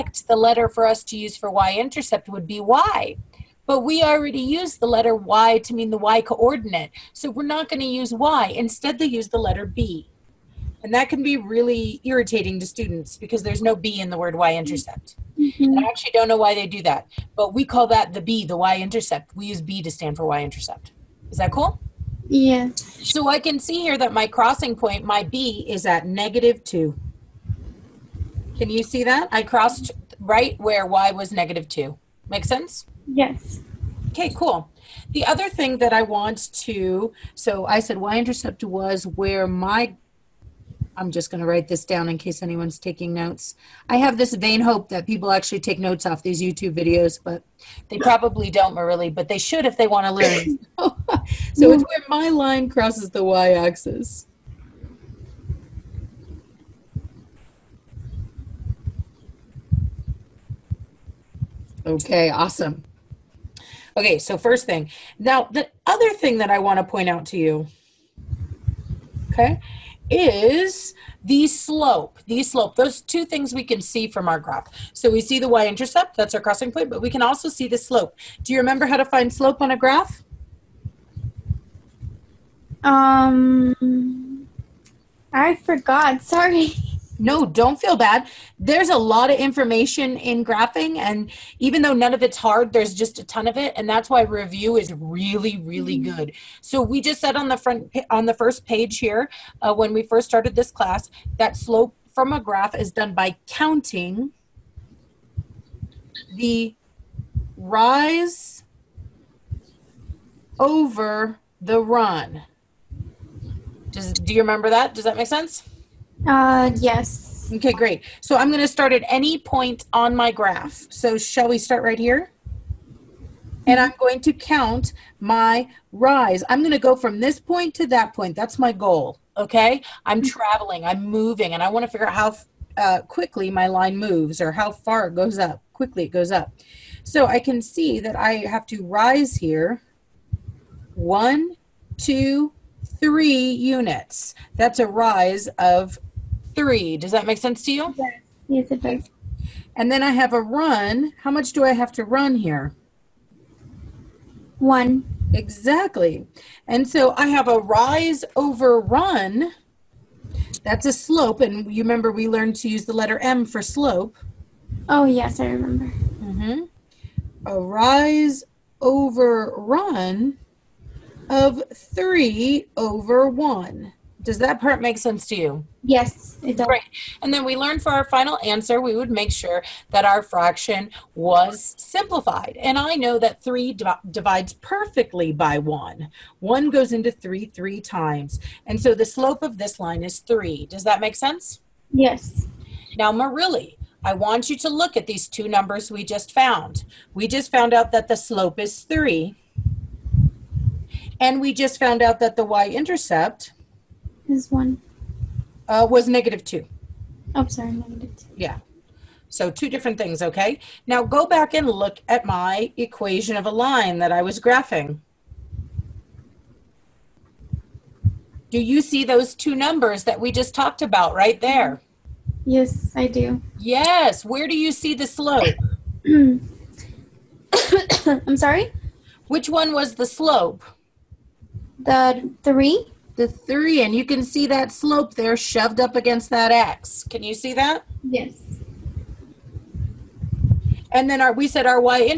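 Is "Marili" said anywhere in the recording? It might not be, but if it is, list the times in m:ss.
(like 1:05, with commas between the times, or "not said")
0:48, 3:13.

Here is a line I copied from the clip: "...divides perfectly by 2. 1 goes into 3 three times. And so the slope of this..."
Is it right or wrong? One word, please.
wrong.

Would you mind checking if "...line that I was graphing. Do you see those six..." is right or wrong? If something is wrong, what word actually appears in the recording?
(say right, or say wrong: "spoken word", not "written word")
wrong: "two", not "six".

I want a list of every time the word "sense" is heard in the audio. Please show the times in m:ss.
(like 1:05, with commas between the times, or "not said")
0:32, 1:55, 2:27, 2:54, 3:11.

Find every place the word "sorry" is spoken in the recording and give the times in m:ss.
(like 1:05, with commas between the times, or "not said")
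1:26, 3:27, 3:48.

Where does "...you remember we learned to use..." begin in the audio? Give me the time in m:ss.
2:41.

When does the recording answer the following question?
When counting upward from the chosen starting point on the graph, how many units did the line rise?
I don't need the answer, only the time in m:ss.
2:24.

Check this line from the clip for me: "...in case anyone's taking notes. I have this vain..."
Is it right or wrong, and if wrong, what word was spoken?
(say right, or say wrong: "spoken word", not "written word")
right.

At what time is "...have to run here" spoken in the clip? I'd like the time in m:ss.
2:31.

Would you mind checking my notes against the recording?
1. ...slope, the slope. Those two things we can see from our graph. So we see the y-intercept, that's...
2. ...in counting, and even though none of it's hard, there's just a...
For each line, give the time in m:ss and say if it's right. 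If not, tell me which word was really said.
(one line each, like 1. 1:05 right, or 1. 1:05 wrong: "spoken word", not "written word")
1. 1:11 right
2. 1:30 wrong: "graphing", not "counting".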